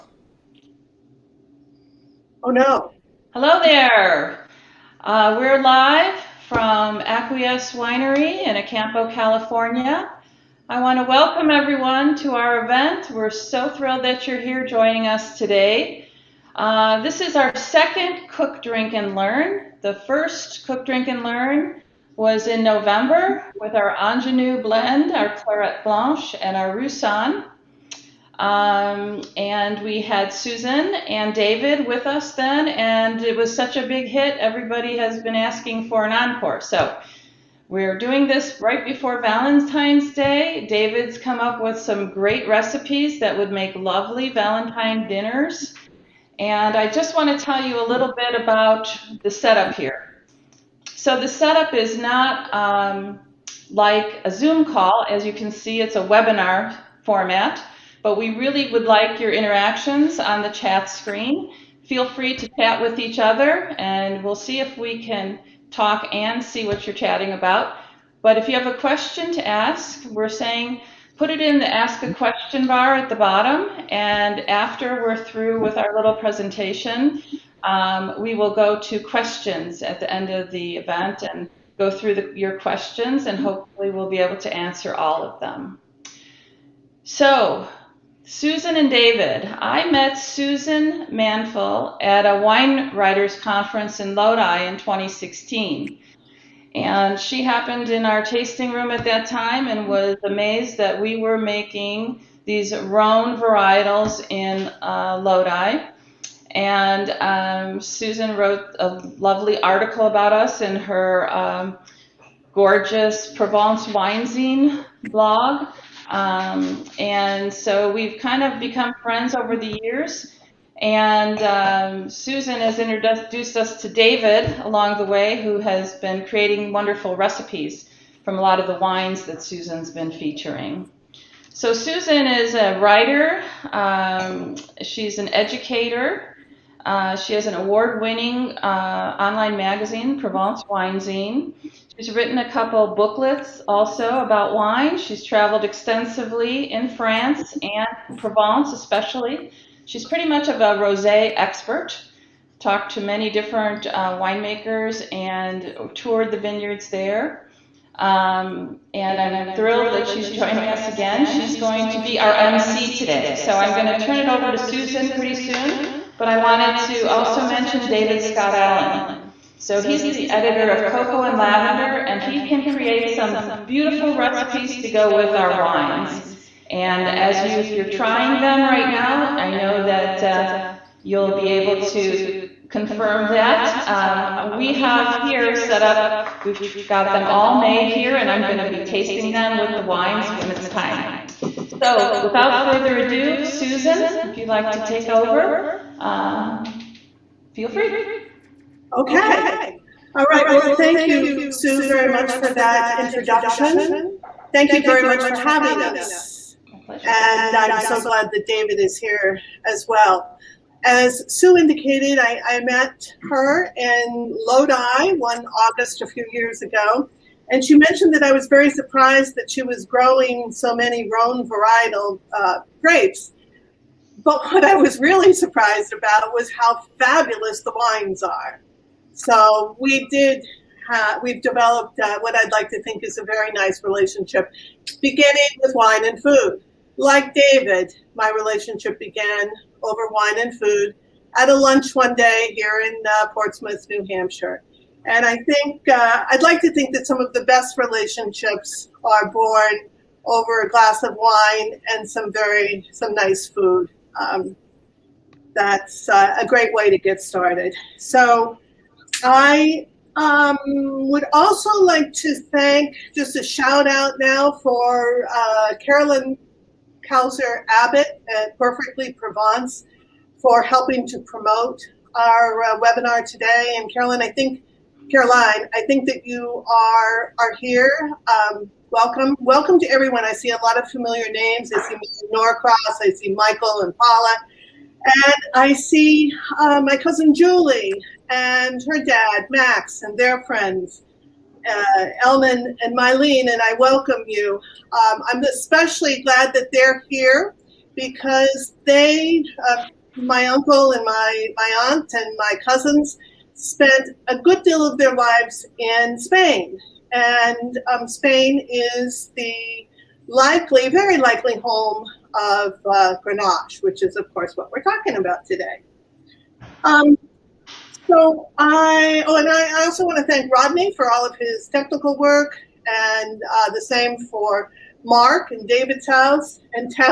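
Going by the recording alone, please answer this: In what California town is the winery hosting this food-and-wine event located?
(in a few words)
Acampo.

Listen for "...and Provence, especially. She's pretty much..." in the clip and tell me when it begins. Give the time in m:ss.
2:27.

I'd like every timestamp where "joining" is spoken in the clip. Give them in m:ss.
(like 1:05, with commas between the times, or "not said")
0:14, 2:40.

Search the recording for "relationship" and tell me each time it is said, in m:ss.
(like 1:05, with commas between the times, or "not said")
3:53, 3:58, 4:07.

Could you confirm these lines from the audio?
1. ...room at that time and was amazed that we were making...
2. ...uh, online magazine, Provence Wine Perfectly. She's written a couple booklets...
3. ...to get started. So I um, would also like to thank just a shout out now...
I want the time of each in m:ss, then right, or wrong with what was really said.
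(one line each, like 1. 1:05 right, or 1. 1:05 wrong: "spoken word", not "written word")
1. 1:38 right
2. 2:18 wrong: "Zine", not "Perfectly"
3. 4:16 right.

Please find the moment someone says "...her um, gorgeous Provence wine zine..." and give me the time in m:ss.
1:50.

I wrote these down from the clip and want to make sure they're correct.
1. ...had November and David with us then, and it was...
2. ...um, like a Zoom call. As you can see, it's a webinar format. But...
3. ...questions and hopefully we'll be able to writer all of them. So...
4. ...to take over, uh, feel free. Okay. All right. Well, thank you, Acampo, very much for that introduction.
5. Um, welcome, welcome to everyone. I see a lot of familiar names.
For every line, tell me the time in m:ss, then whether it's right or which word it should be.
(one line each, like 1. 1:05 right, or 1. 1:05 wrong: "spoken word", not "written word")
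1. 0:30 wrong: "Susan", not "November"
2. 0:52 right
3. 1:22 wrong: "answer", not "writer"
4. 3:14 wrong: "Sue", not "Acampo"
5. 4:38 right.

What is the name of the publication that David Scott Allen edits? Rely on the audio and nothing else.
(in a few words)
Cocoa and Lavender.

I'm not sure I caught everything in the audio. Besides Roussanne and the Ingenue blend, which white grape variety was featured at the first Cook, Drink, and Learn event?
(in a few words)
Clairette Blanche.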